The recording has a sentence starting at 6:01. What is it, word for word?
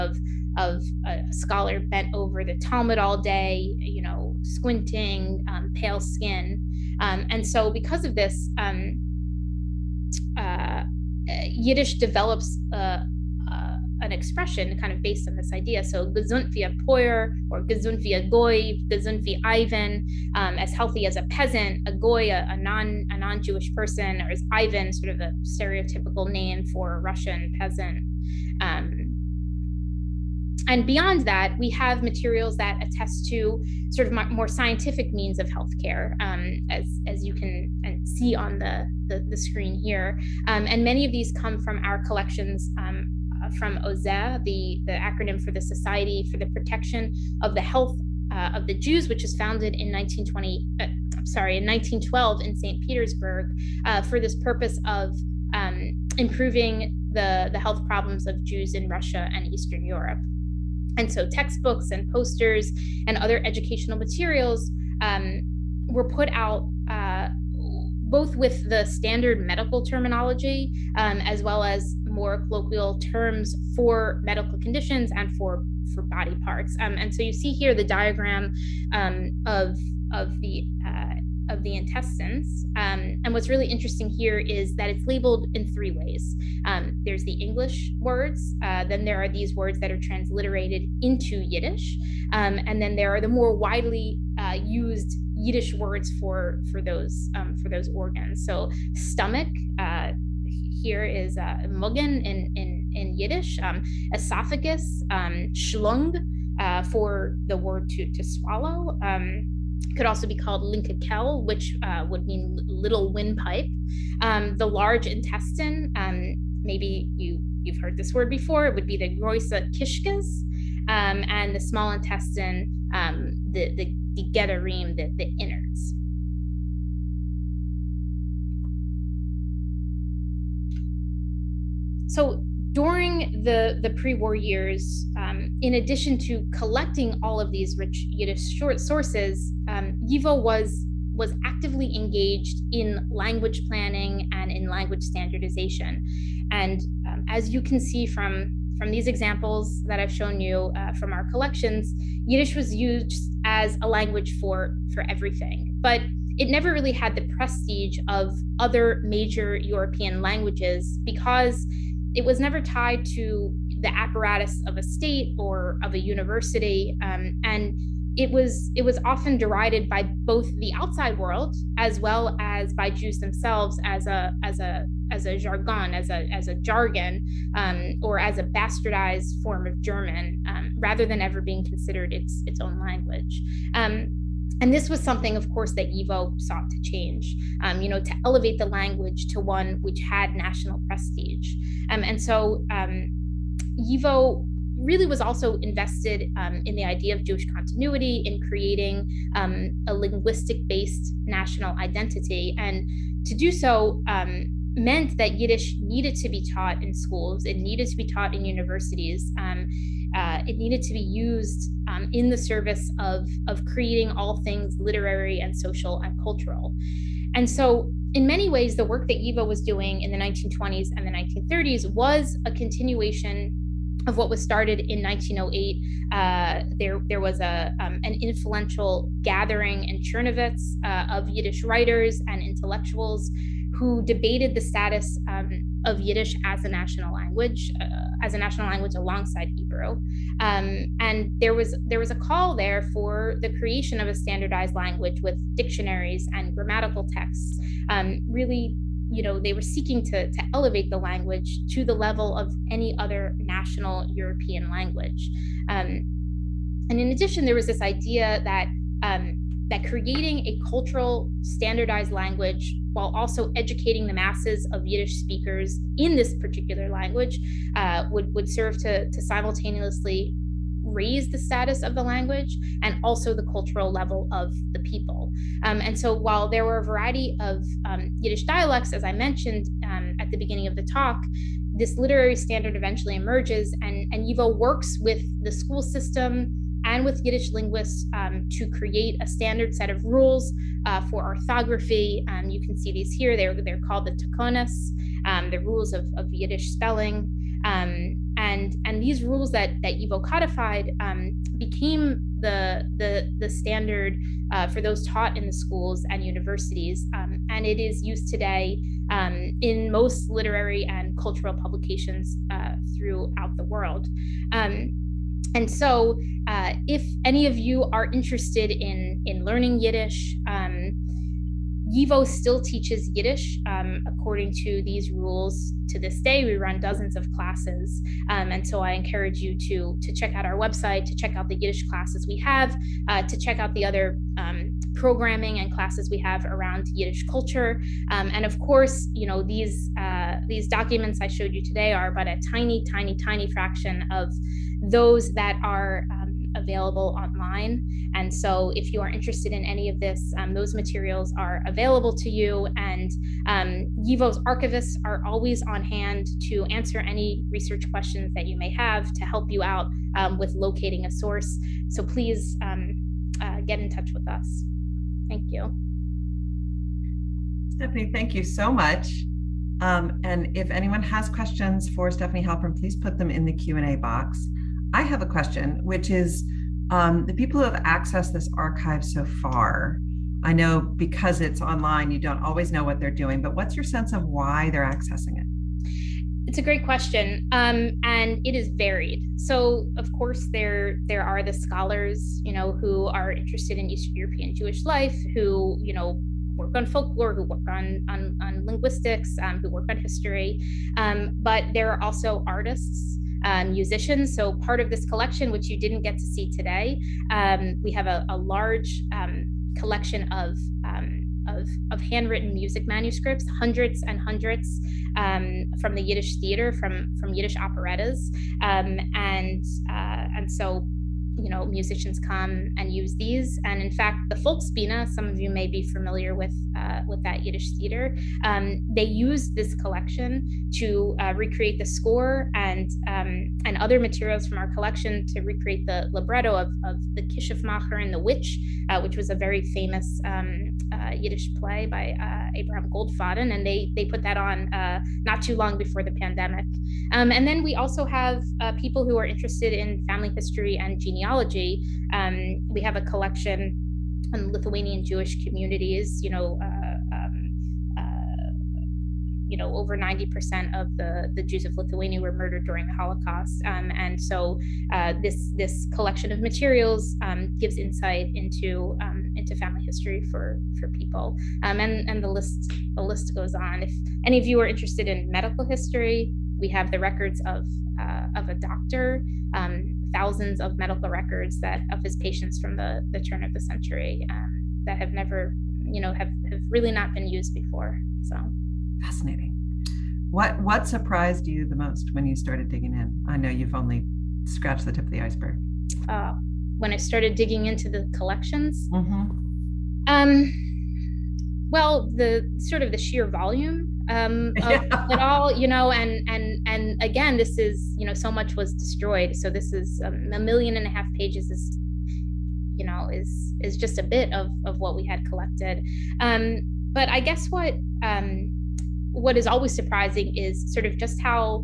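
So please, um, uh, get in touch with us.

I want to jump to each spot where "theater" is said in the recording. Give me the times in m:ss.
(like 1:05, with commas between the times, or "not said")
6:56, 7:07.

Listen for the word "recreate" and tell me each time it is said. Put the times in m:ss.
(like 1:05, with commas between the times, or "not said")
7:11, 7:15.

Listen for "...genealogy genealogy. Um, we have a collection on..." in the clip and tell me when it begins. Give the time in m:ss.
7:30.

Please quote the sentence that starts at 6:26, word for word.
It's a great question, um, and it is varied.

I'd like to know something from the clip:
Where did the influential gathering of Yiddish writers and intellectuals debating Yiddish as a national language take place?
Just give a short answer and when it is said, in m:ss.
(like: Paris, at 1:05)
Chernovitz, at 3:49.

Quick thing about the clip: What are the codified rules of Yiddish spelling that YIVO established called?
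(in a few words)
takonas.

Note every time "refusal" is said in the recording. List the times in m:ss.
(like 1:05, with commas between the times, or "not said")
not said.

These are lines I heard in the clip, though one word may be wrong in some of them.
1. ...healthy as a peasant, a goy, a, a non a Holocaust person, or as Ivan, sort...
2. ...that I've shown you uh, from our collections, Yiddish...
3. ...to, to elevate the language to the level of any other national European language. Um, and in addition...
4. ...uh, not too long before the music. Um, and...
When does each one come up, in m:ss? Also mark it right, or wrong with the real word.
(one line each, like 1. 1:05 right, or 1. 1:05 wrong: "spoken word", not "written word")
1. 0:20 wrong: "Jewish", not "Holocaust"
2. 2:29 right
3. 4:10 right
4. 7:24 wrong: "pandemic", not "music".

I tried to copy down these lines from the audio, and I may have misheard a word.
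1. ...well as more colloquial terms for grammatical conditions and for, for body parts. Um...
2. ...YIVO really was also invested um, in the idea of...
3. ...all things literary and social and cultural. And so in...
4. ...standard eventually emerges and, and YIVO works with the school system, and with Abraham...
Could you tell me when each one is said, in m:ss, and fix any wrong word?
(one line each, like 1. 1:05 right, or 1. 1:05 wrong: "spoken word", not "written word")
1. 1:11 wrong: "medical", not "grammatical"
2. 3:13 right
3. 3:34 right
4. 4:42 wrong: "Yiddish", not "Abraham".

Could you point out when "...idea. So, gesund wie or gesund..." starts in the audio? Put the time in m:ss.
0:15.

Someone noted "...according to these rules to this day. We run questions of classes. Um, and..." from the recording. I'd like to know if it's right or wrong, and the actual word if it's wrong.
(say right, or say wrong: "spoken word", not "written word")
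wrong: "dozens", not "questions".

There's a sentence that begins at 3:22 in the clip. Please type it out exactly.
And to do so, um, meant that Yiddish needed to be taught in schools, it needed to be taught in universities.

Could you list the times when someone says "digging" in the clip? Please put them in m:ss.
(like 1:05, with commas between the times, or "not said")
8:12, 8:17.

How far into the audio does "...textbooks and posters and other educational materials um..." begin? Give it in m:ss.
1:01.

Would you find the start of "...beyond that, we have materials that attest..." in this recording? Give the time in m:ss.
0:30.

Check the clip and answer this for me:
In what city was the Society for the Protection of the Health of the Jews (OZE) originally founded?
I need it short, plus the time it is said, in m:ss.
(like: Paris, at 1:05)
St. Petersburg, at 0:52.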